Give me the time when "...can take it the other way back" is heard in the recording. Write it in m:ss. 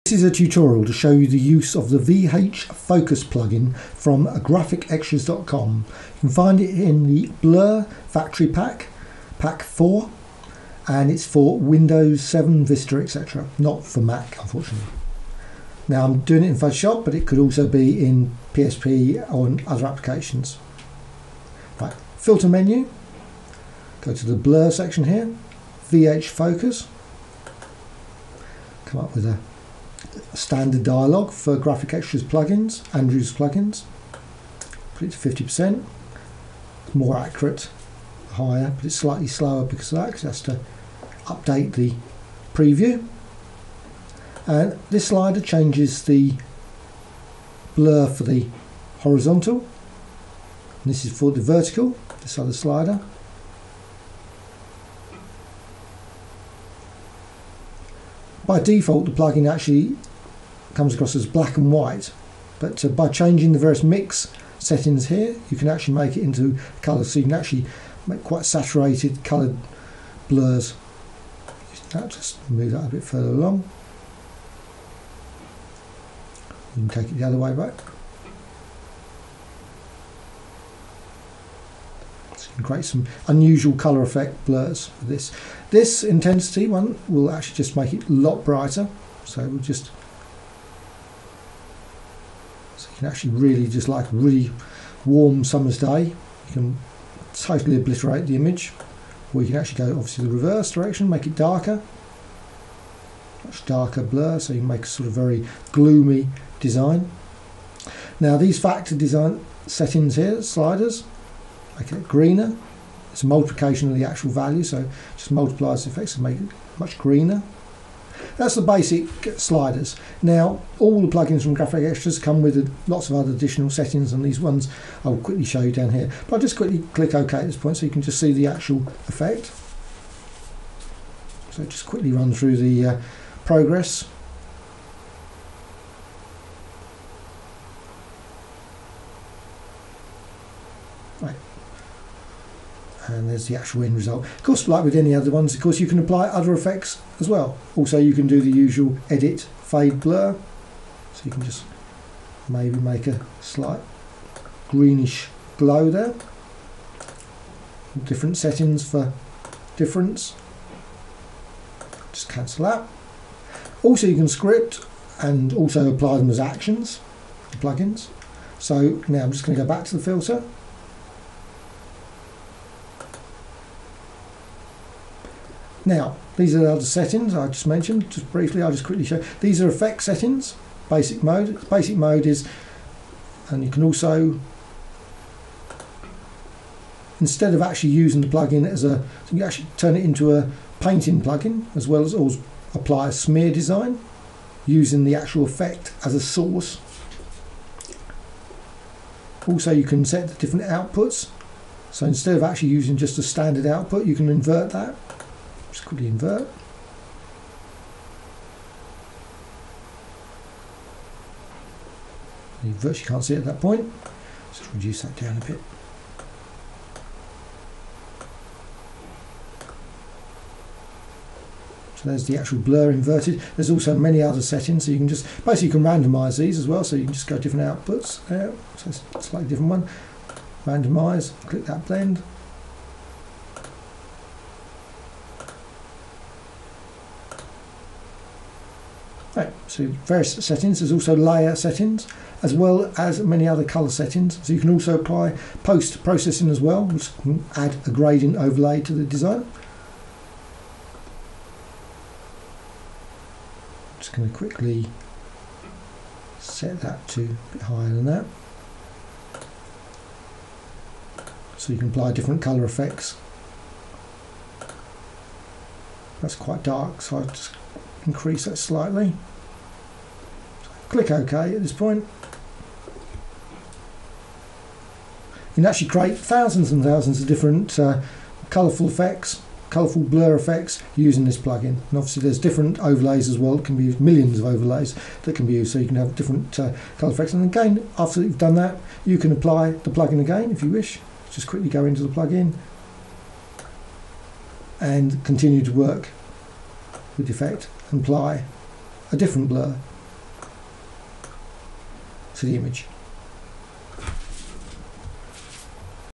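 1:16.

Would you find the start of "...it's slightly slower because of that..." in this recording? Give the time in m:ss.
0:38.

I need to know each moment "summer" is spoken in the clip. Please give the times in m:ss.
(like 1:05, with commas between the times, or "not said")
1:35.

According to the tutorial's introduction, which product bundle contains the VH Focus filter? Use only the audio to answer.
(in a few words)
Blur Factory Pack.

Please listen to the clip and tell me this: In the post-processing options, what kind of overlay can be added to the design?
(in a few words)
Gradient overlay.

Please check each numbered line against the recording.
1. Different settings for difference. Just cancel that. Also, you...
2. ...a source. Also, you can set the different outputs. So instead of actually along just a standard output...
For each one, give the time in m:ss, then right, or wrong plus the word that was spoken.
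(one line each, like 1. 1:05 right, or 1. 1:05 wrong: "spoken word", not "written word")
1. 2:38 right
2. 3:16 wrong: "using", not "along".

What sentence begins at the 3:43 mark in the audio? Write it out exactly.
There's also many other settings, so you can just basically you can randomize these as well.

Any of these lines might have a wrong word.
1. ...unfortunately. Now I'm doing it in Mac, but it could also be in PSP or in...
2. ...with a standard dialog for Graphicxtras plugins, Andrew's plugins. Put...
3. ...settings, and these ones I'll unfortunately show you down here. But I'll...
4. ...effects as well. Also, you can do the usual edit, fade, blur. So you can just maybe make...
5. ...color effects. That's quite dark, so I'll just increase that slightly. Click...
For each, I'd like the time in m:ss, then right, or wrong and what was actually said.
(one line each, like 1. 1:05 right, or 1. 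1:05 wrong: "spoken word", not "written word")
1. 0:14 wrong: "Photoshop", not "Mac"
2. 0:29 right
3. 2:03 wrong: "quickly", not "unfortunately"
4. 2:26 right
5. 4:22 right.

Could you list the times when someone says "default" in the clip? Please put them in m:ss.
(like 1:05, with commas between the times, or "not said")
0:58.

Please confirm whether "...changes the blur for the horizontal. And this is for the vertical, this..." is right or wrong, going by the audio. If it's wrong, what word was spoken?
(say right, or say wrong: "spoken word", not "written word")
right.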